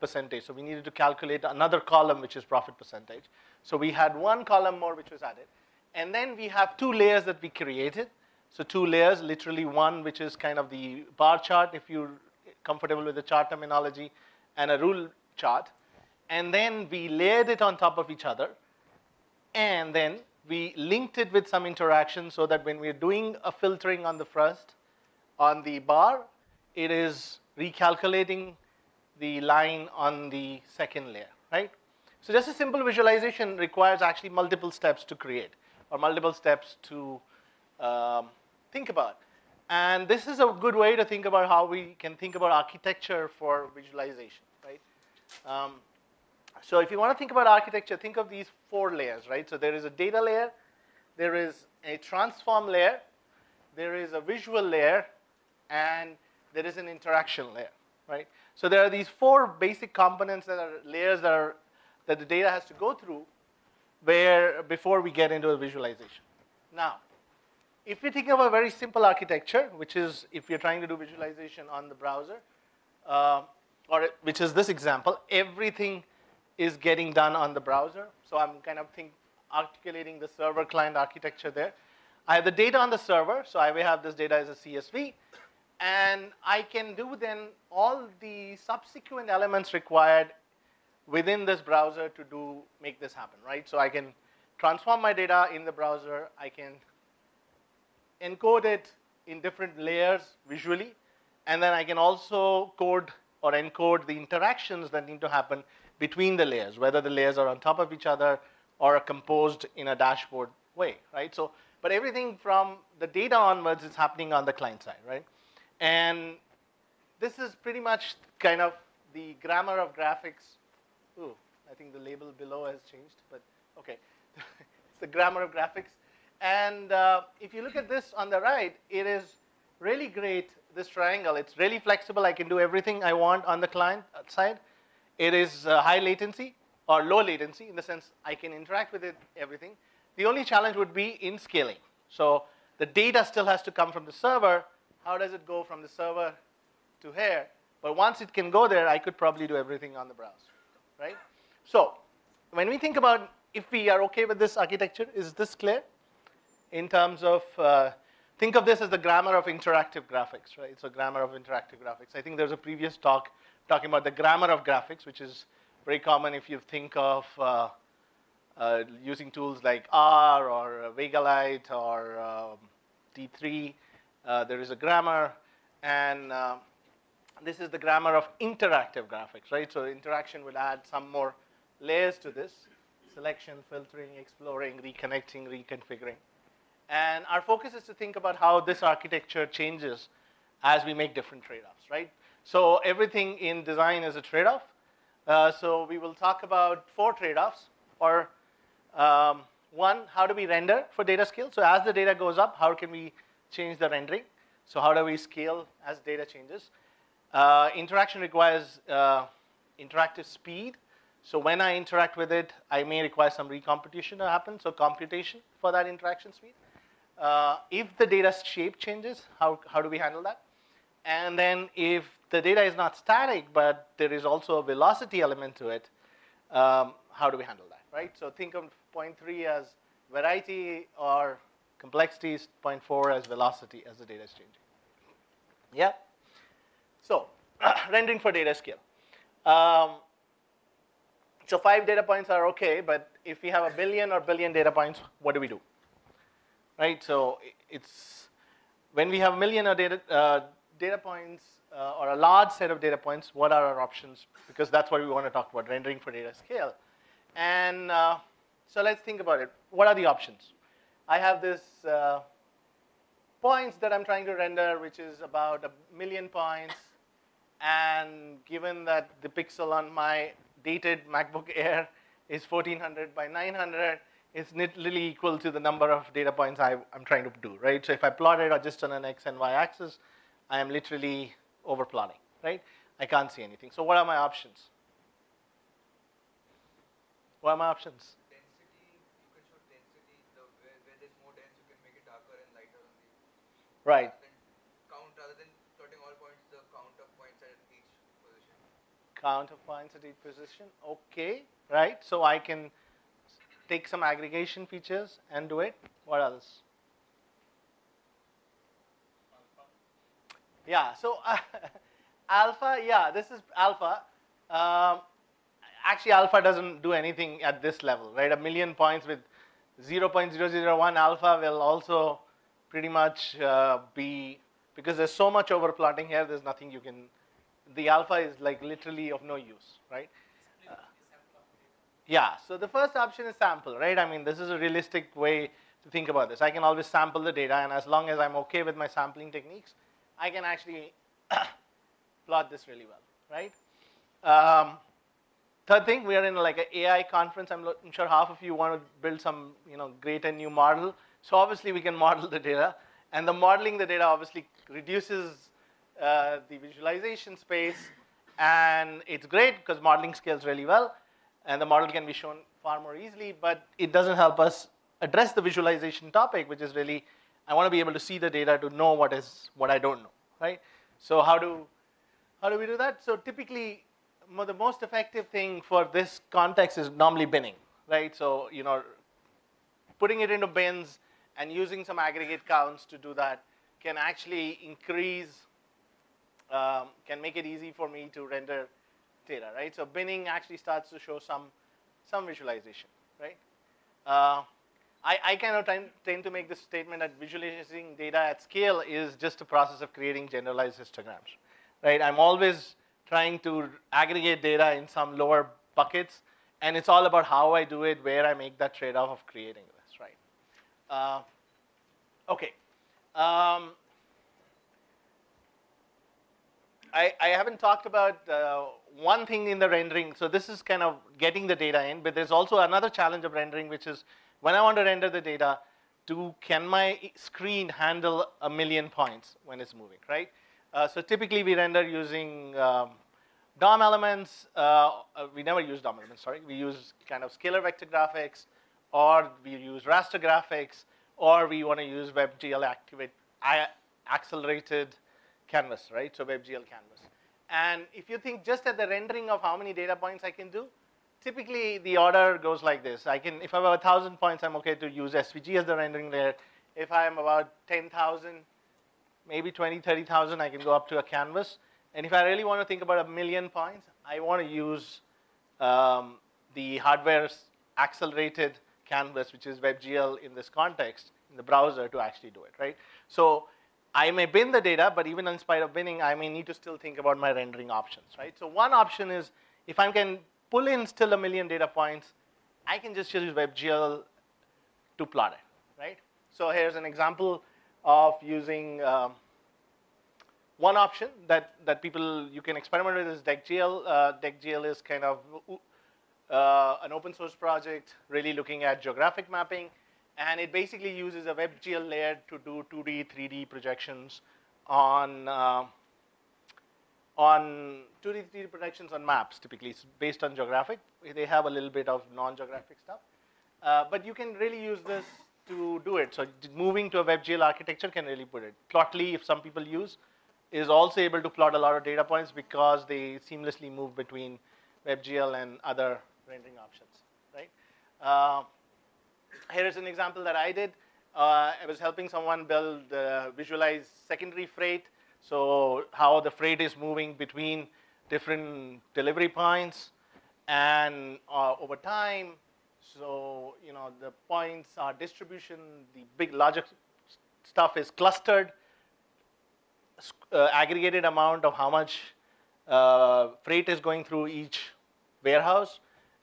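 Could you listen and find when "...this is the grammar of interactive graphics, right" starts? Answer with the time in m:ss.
2:57.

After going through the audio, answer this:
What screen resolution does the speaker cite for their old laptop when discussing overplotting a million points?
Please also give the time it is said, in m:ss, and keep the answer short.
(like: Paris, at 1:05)
1400 by 900, at 4:32.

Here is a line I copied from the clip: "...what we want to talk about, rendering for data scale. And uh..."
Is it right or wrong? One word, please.
right.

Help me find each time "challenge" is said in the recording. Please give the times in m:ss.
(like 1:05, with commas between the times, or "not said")
2:20, 7:02.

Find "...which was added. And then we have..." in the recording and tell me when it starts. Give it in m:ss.
0:04.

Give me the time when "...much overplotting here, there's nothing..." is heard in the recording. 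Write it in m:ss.
5:25.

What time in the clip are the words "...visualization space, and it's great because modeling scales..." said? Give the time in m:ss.
5:56.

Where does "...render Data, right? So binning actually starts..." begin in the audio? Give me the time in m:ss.
6:28.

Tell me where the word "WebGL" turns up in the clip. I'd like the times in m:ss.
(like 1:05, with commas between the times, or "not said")
7:22, 7:26, 7:49, 8:03, 8:21, 8:37, 8:44.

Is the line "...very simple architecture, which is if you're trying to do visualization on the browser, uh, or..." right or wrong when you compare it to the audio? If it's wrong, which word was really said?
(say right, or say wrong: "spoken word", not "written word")
right.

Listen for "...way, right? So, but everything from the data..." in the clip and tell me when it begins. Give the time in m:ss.
1:50.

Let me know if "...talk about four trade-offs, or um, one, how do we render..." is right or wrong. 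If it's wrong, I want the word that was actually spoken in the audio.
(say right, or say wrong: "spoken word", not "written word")
right.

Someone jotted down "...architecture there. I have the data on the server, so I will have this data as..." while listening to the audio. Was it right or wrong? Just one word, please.
right.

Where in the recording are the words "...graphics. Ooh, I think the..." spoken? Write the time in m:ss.
1:59.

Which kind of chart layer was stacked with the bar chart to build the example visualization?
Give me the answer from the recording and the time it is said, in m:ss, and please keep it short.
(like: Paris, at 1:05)
Rule chart, at 0:14.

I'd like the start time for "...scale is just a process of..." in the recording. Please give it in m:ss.
6:38.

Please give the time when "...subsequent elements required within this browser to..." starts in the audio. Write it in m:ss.
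1:28.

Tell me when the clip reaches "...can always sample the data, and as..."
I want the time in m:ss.
5:36.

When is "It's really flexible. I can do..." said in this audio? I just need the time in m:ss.
2:11.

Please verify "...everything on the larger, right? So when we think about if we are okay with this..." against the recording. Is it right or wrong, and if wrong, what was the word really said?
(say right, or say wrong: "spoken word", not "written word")
wrong: "browser", not "larger".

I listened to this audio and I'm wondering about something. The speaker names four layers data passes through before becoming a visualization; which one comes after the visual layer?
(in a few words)
Interaction layer.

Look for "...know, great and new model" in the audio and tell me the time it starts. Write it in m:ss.
5:49.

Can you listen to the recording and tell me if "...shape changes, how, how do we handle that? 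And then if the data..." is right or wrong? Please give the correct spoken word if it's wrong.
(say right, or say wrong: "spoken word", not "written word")
right.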